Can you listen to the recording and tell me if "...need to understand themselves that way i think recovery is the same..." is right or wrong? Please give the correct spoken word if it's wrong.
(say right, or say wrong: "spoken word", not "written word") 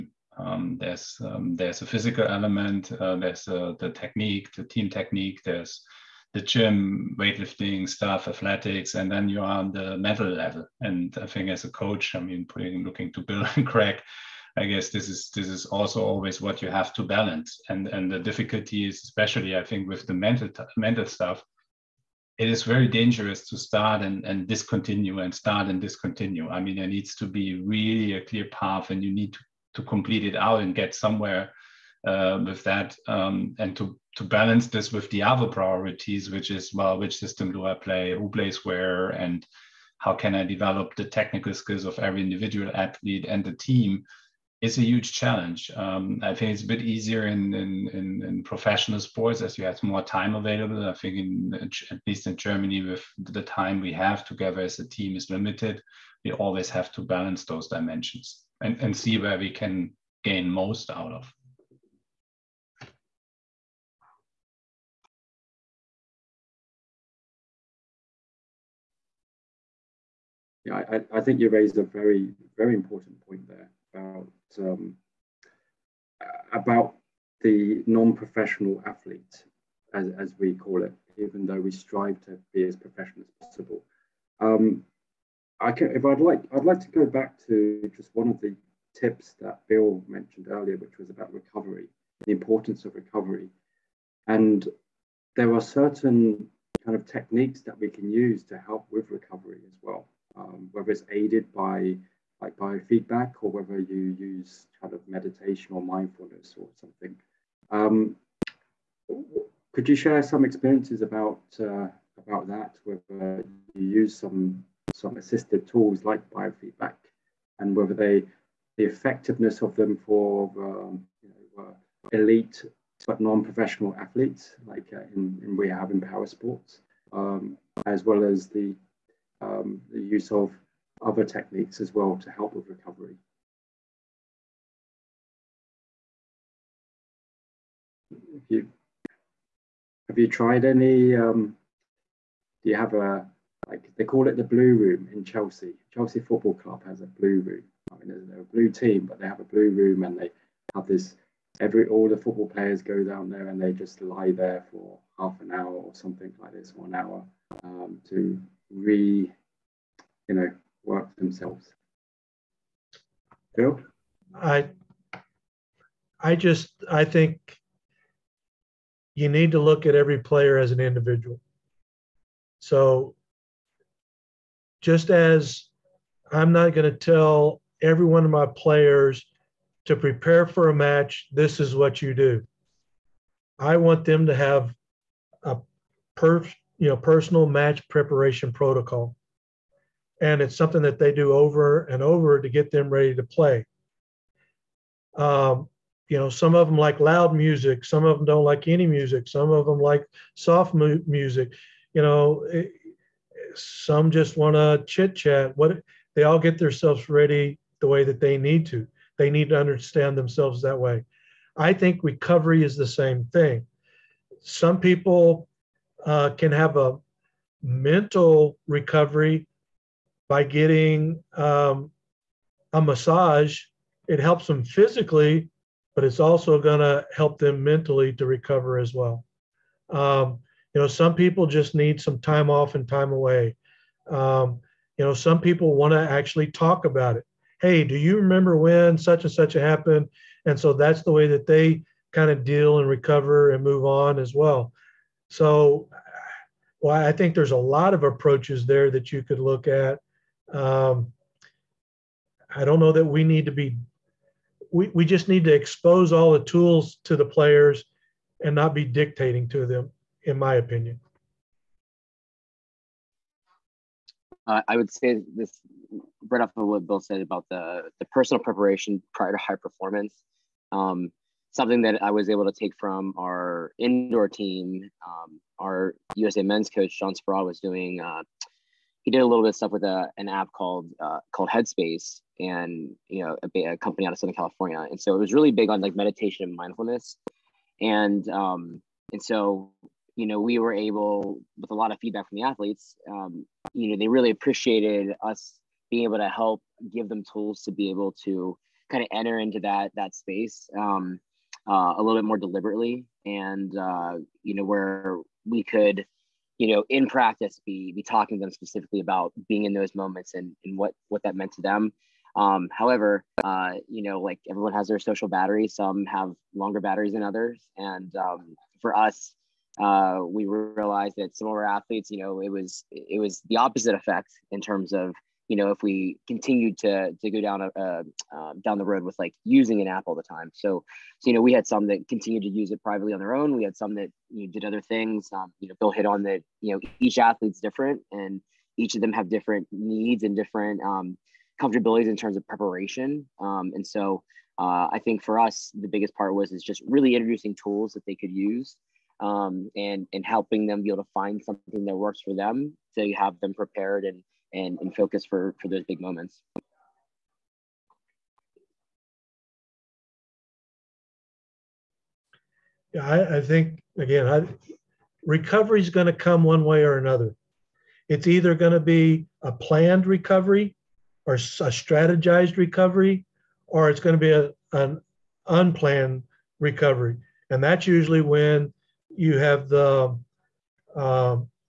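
right.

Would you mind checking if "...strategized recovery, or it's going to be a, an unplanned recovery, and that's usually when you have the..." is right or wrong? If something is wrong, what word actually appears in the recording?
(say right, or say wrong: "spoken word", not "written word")
right.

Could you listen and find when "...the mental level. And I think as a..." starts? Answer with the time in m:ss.
0:09.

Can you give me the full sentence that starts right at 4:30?
Um, something that I was able to take from our indoor team.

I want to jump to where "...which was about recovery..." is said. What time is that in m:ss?
1:30.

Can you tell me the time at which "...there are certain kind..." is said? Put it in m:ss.
1:35.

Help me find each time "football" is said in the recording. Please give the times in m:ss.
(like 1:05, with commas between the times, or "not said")
2:26, 2:32.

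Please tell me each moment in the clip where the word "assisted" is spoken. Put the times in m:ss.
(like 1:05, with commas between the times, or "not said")
1:55.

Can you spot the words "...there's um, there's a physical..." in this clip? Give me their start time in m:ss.
0:00.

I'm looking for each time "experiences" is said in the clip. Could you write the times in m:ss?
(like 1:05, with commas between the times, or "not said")
1:50.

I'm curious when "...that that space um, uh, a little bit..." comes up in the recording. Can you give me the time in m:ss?
4:59.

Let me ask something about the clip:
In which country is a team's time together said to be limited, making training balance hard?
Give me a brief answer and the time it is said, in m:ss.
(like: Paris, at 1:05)
Germany, at 0:52.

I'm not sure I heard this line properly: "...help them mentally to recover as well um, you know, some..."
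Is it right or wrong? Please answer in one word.
right.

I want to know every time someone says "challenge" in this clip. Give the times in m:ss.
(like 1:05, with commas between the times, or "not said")
0:45.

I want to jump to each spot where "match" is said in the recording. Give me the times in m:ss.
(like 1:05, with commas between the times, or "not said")
3:00, 3:07.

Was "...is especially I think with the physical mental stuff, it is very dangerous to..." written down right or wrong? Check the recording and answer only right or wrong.
wrong.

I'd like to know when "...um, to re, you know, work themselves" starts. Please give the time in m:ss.
2:37.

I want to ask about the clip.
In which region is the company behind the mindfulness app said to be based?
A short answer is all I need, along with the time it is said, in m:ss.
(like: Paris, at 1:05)
Southern California, at 4:44.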